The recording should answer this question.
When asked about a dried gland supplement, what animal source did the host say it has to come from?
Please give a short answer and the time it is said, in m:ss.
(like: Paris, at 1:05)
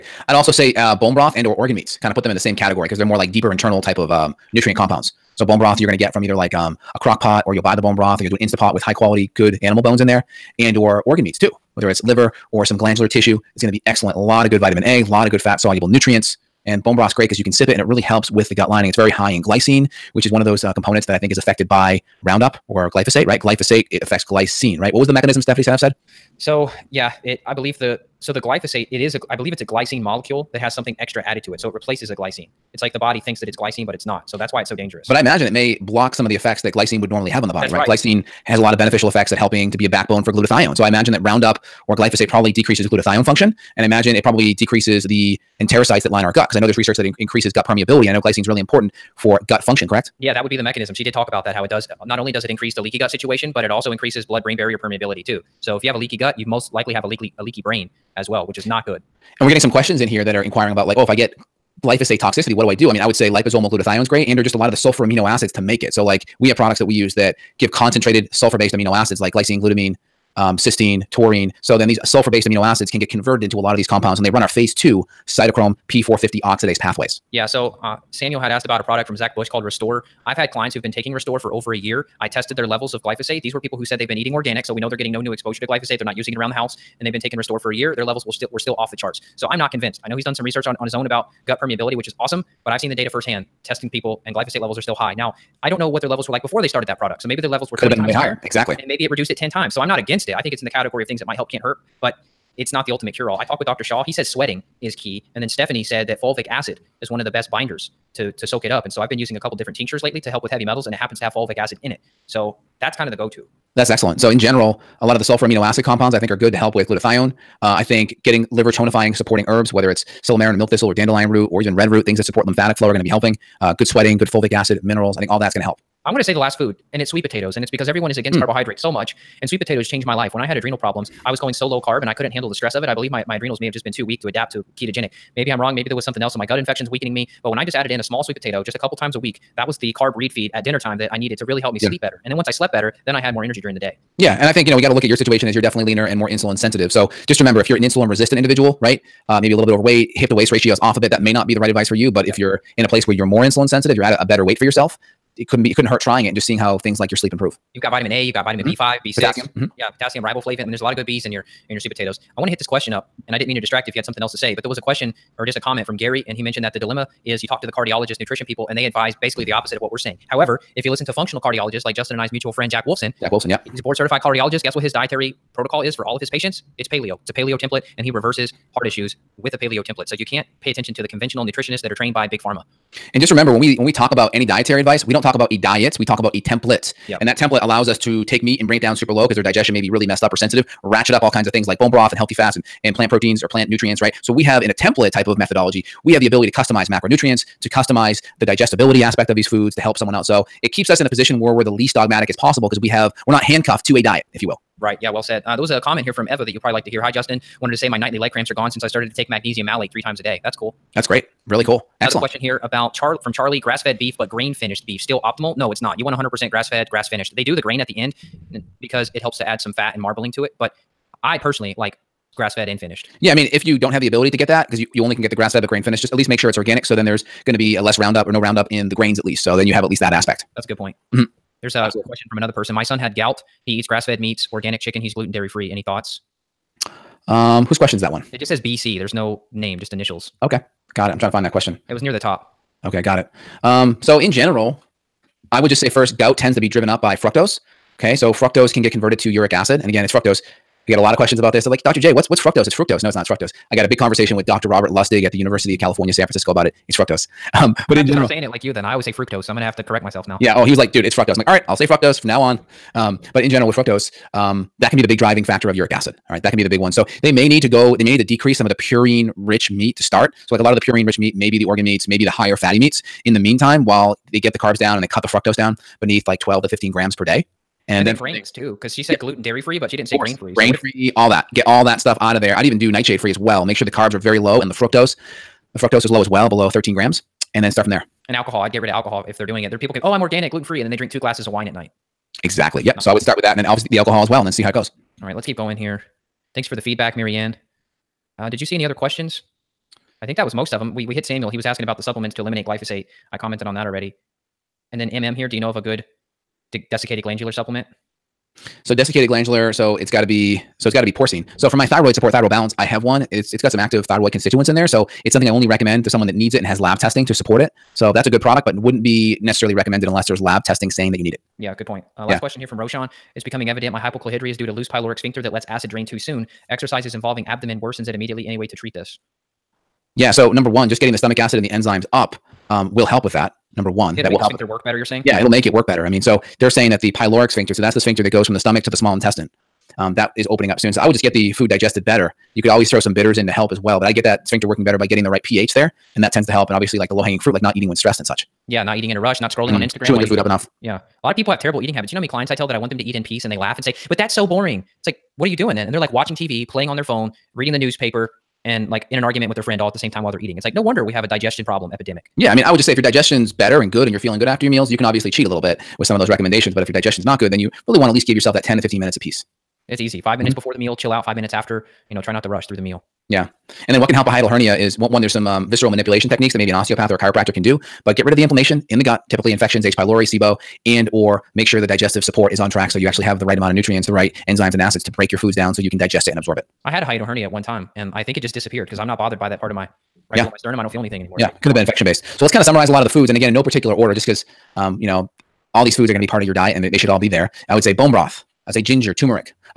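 porcine, at 5:11.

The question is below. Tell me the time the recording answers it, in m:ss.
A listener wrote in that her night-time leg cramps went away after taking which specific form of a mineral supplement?
3:29.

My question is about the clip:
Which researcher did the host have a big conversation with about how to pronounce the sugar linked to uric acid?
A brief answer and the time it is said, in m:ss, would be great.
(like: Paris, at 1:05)
Robert Lustig, at 4:14.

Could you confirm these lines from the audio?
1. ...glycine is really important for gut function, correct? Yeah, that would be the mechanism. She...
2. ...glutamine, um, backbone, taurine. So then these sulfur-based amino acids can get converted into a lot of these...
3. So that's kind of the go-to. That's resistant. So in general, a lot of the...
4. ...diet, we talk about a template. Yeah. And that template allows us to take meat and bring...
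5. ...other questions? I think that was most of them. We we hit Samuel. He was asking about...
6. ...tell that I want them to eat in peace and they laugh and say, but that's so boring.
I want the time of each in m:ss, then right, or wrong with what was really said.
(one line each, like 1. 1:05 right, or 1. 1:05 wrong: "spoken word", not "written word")
1. 0:48 right
2. 1:09 wrong: "cysteine", not "backbone"
3. 1:52 wrong: "excellent", not "resistant"
4. 3:05 right
5. 4:58 right
6. 5:52 right.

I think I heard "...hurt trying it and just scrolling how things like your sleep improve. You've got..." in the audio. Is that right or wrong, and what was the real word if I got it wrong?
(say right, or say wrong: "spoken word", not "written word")
wrong: "seeing", not "scrolling".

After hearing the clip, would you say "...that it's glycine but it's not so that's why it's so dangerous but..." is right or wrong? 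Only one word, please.
right.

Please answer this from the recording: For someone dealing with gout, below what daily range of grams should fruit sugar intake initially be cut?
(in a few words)
12 to 15 grams.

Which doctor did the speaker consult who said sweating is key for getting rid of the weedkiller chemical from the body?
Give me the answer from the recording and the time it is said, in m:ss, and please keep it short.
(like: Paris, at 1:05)
Dr. Shaw, at 1:43.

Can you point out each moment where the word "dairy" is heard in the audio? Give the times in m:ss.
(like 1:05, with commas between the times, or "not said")
3:55, 4:39.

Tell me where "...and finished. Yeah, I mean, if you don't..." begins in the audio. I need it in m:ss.
3:42.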